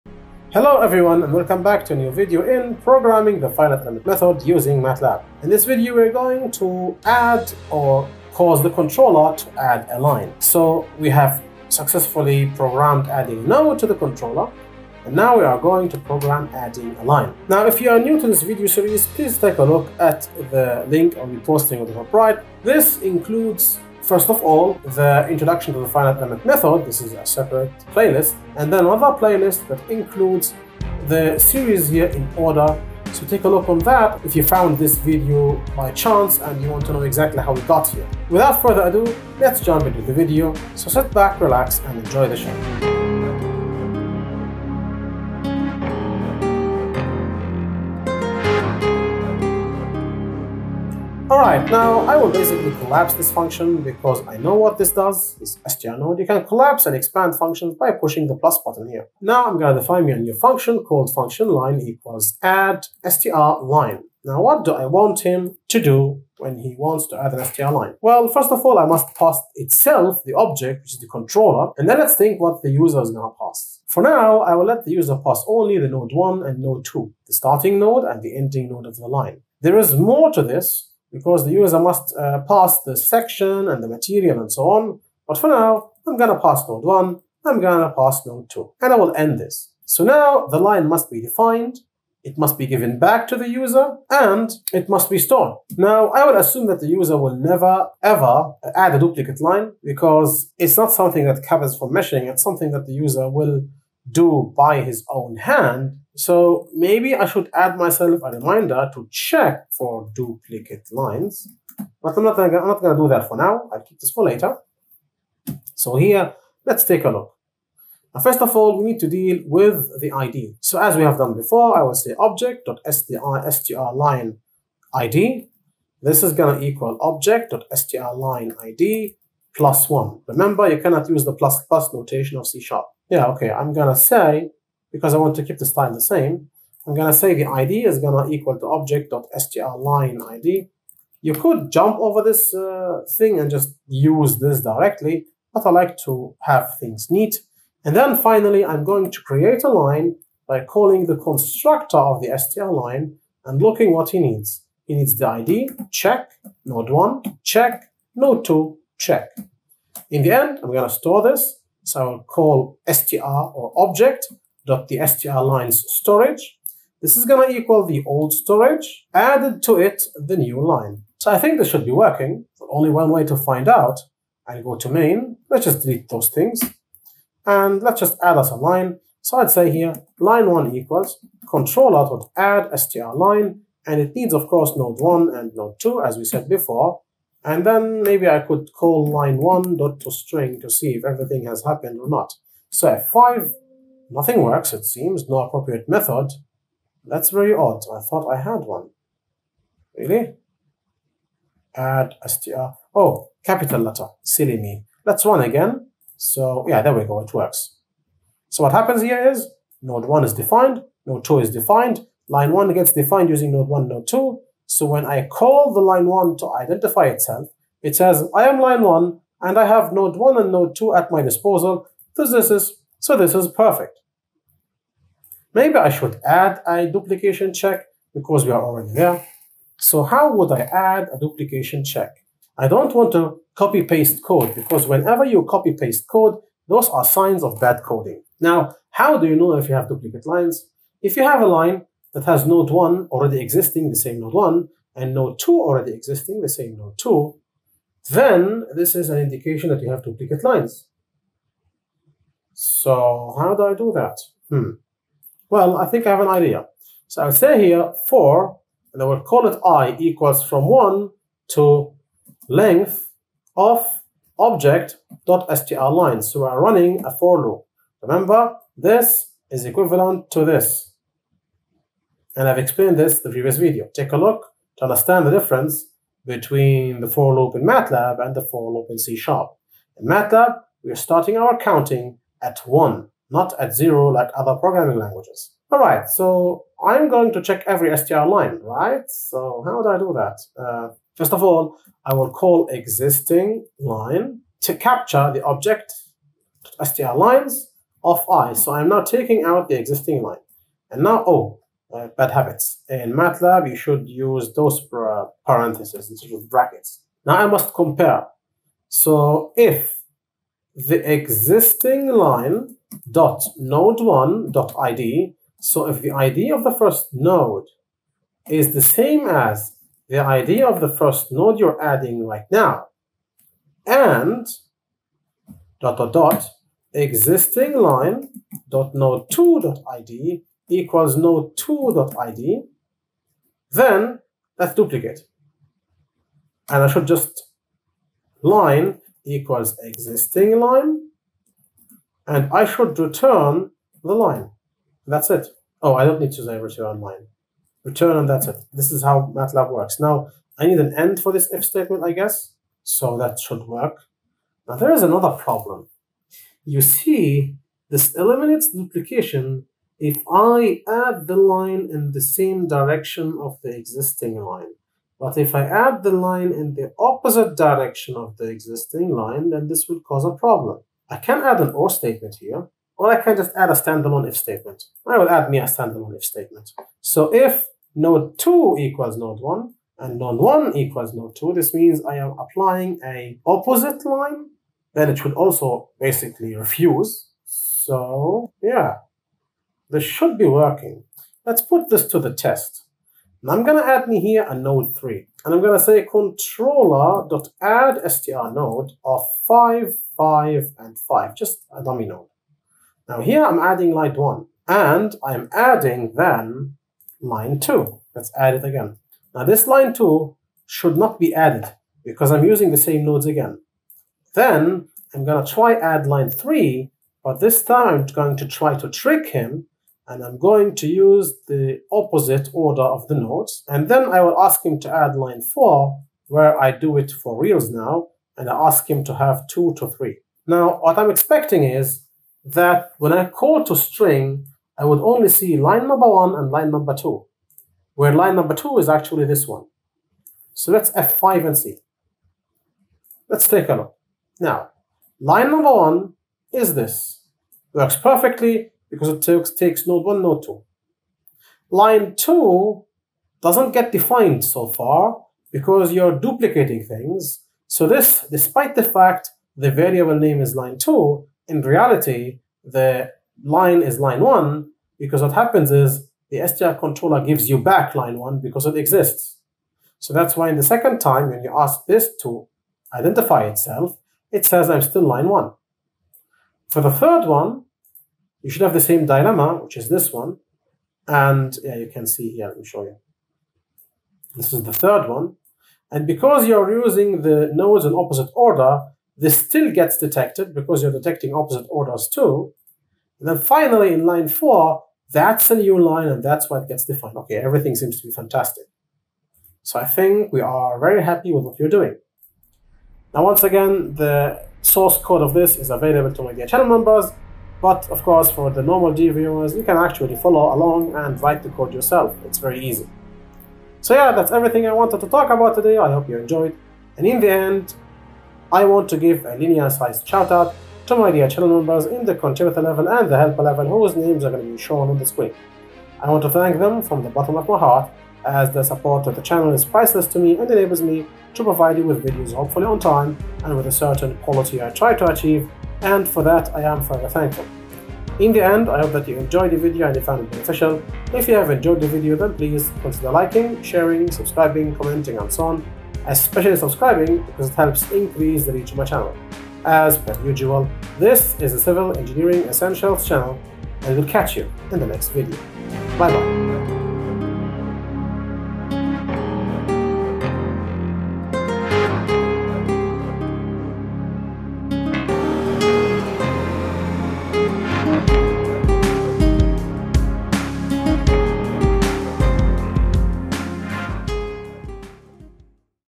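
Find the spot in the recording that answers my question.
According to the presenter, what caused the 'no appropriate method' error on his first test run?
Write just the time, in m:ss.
3:23.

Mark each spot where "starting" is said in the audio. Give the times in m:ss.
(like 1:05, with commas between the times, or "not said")
1:17, 4:40.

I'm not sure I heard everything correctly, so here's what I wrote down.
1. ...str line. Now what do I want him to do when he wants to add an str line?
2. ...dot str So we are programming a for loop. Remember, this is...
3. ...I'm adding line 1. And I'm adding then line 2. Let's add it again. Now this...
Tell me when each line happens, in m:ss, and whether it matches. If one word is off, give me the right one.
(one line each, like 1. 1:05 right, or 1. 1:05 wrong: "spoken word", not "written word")
1. 1:03 right
2. 4:25 wrong: "running", not "programming"
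3. 6:43 right.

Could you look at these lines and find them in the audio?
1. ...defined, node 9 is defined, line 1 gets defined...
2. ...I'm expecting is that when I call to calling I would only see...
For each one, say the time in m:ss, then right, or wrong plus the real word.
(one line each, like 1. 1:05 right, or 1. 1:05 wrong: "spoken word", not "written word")
1. 3:30 wrong: "2", not "9"
2. 7:10 wrong: "string", not "calling".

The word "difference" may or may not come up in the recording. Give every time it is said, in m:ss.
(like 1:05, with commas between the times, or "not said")
4:35.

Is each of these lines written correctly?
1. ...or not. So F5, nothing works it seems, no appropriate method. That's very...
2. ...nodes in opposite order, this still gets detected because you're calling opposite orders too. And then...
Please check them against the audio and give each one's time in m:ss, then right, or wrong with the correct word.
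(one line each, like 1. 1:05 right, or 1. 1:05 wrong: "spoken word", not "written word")
1. 3:11 right
2. 8:07 wrong: "detecting", not "calling".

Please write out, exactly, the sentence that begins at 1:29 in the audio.
So now the line must be defined, it must be given back to the user, and it must be stored.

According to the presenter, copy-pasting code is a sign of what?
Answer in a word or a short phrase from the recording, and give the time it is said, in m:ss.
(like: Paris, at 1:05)
bad coding, at 3:57.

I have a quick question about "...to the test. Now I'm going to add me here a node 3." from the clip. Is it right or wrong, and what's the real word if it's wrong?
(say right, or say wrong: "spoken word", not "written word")
right.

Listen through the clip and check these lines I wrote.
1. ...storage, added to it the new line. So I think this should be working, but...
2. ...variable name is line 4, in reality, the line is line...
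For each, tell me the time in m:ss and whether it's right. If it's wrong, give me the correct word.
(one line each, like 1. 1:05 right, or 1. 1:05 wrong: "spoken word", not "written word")
1. 2:48 right
2. 7:39 wrong: "2", not "4".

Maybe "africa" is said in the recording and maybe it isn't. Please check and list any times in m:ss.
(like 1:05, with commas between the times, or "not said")
not said.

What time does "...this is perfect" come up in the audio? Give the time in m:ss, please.
3:43.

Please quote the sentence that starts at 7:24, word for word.
Now line number 1 is this.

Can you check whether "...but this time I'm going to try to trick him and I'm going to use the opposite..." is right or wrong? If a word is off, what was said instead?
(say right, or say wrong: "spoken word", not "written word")
right.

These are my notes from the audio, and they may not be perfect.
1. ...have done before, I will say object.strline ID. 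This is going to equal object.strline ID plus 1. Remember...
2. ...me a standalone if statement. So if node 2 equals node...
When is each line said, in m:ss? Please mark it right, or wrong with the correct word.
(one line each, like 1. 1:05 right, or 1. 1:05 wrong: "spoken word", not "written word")
1. 2:01 right
2. 6:15 right.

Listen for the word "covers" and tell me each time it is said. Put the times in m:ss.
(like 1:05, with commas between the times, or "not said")
1:41.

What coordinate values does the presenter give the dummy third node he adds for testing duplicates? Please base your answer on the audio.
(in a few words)
5, 5, and 5.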